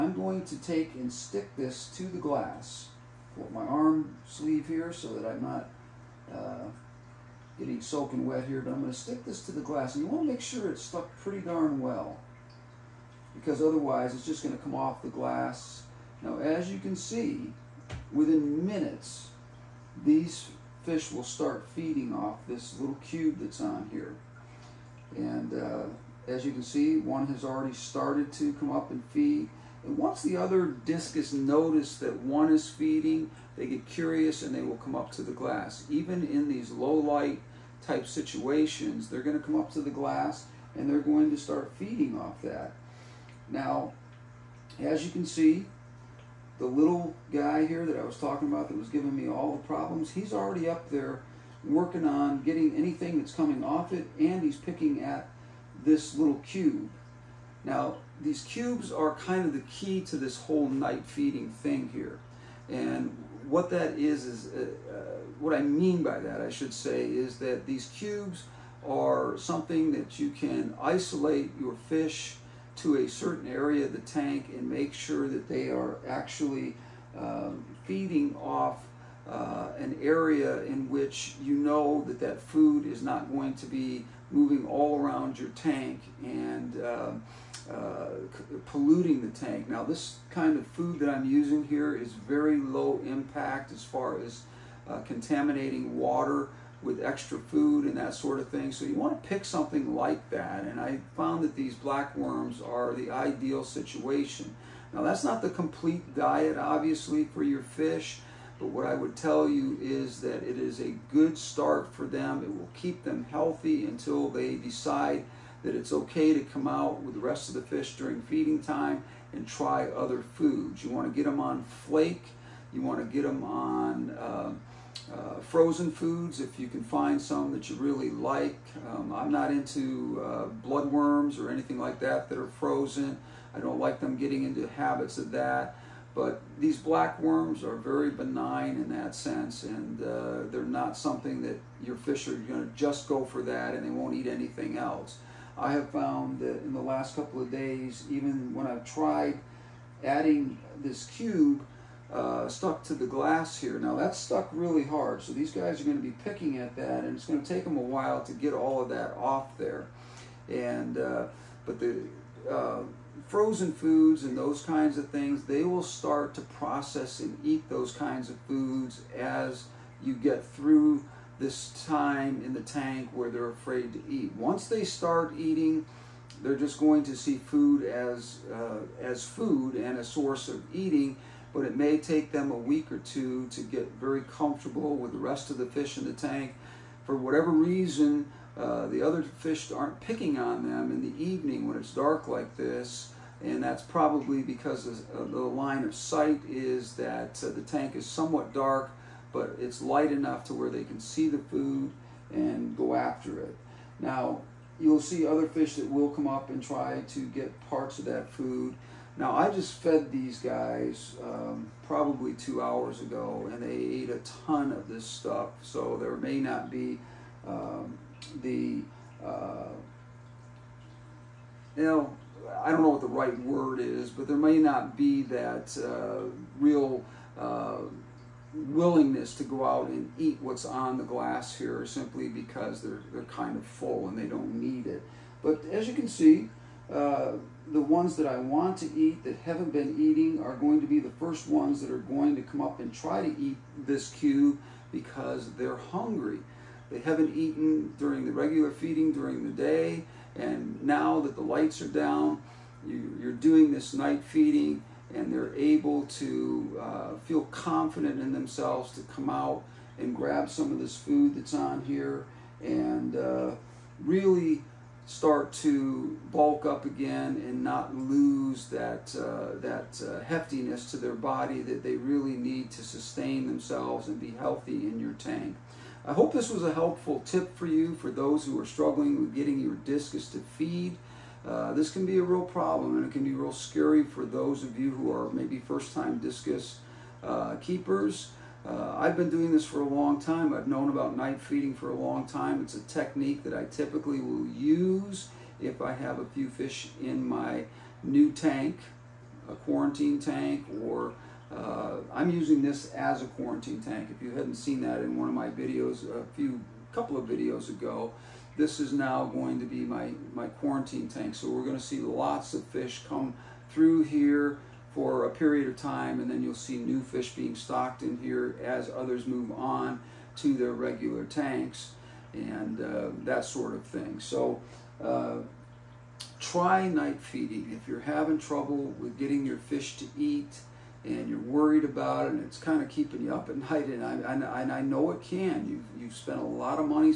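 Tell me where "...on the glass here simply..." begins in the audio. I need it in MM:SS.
03:50.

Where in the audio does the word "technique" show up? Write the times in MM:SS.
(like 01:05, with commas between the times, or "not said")
04:52.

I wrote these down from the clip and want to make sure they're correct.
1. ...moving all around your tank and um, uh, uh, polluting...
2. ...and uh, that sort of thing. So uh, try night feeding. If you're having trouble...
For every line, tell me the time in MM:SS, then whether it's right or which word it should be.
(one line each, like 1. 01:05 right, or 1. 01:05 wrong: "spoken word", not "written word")
1. 01:24 right
2. 05:22 right.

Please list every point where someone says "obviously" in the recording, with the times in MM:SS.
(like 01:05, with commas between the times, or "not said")
01:46.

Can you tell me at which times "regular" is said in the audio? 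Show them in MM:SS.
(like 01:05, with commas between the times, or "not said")
04:08, 05:20.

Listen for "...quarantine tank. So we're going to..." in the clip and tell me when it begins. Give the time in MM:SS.
05:10.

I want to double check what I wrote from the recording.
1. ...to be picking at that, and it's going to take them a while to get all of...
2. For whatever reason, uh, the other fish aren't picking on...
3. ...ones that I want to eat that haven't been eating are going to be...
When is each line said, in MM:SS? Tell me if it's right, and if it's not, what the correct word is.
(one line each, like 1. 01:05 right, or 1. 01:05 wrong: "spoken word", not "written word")
1. 02:35 right
2. 03:07 right
3. 03:57 right.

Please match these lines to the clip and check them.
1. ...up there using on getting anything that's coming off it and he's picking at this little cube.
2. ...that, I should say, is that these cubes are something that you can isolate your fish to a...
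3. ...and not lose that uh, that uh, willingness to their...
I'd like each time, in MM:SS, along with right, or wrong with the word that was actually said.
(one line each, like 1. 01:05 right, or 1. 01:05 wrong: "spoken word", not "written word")
1. 00:50 wrong: "working", not "using"
2. 01:06 right
3. 04:27 wrong: "heftiness", not "willingness".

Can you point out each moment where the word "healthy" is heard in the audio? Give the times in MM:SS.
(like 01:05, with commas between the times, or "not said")
01:53, 04:34.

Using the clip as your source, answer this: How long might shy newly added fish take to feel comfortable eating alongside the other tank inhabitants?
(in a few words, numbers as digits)
a week or two.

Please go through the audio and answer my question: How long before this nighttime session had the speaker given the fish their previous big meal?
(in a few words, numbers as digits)
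2 hours.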